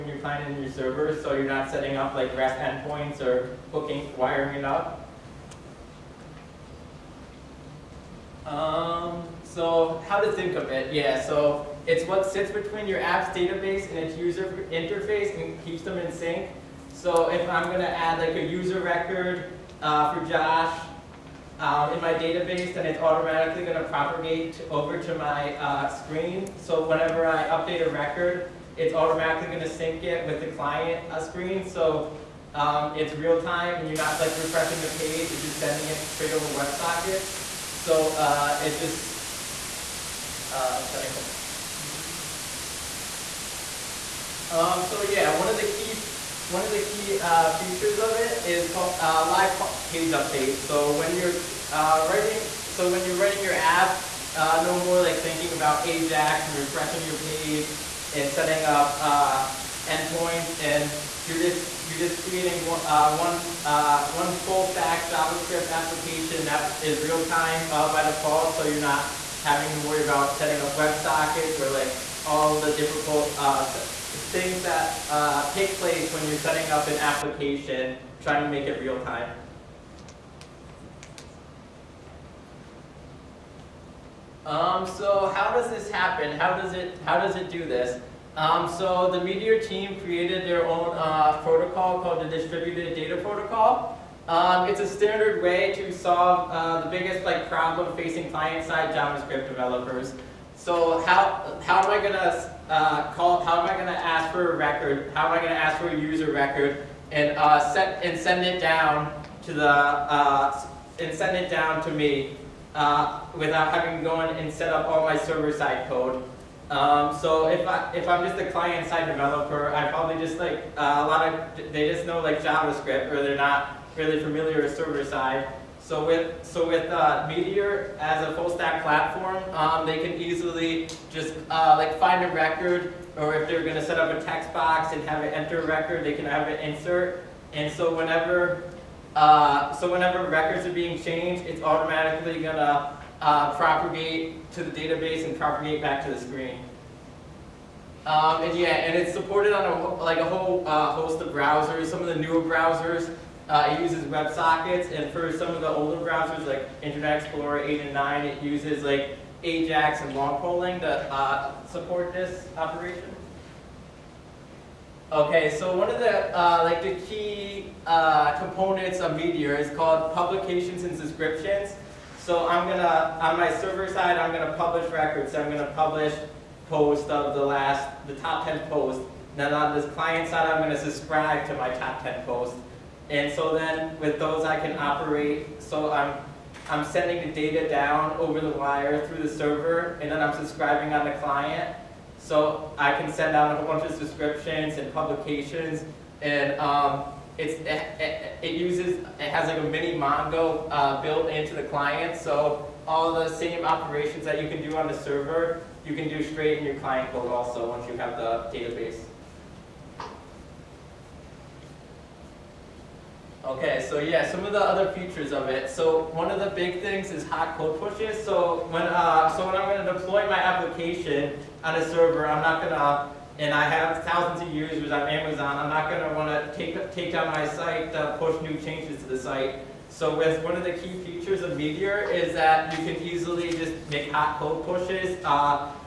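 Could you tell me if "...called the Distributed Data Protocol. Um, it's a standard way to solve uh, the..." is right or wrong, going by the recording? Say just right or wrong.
right.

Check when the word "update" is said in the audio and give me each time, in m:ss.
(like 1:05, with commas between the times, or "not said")
0:27, 0:50.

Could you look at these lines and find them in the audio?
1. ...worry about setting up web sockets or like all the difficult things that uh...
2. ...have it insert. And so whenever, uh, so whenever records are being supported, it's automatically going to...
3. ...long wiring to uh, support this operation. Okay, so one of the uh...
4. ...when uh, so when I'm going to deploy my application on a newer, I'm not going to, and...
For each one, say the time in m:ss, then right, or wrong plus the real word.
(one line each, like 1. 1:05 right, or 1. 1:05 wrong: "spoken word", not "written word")
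1. 1:09 right
2. 2:16 wrong: "changed", not "supported"
3. 2:40 wrong: "polling", not "wiring"
4. 3:38 wrong: "server", not "newer".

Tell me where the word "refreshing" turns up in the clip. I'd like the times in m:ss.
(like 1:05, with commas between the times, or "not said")
0:34, 0:56.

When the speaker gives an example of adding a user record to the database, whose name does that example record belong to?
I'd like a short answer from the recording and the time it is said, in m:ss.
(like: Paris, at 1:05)
Josh, at 0:20.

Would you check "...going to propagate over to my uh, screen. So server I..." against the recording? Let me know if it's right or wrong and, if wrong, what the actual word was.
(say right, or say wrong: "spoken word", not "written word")
wrong: "whenever", not "server".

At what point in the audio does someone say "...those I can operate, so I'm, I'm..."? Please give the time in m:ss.
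3:04.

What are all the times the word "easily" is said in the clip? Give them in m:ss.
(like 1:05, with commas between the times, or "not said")
2:10, 3:53.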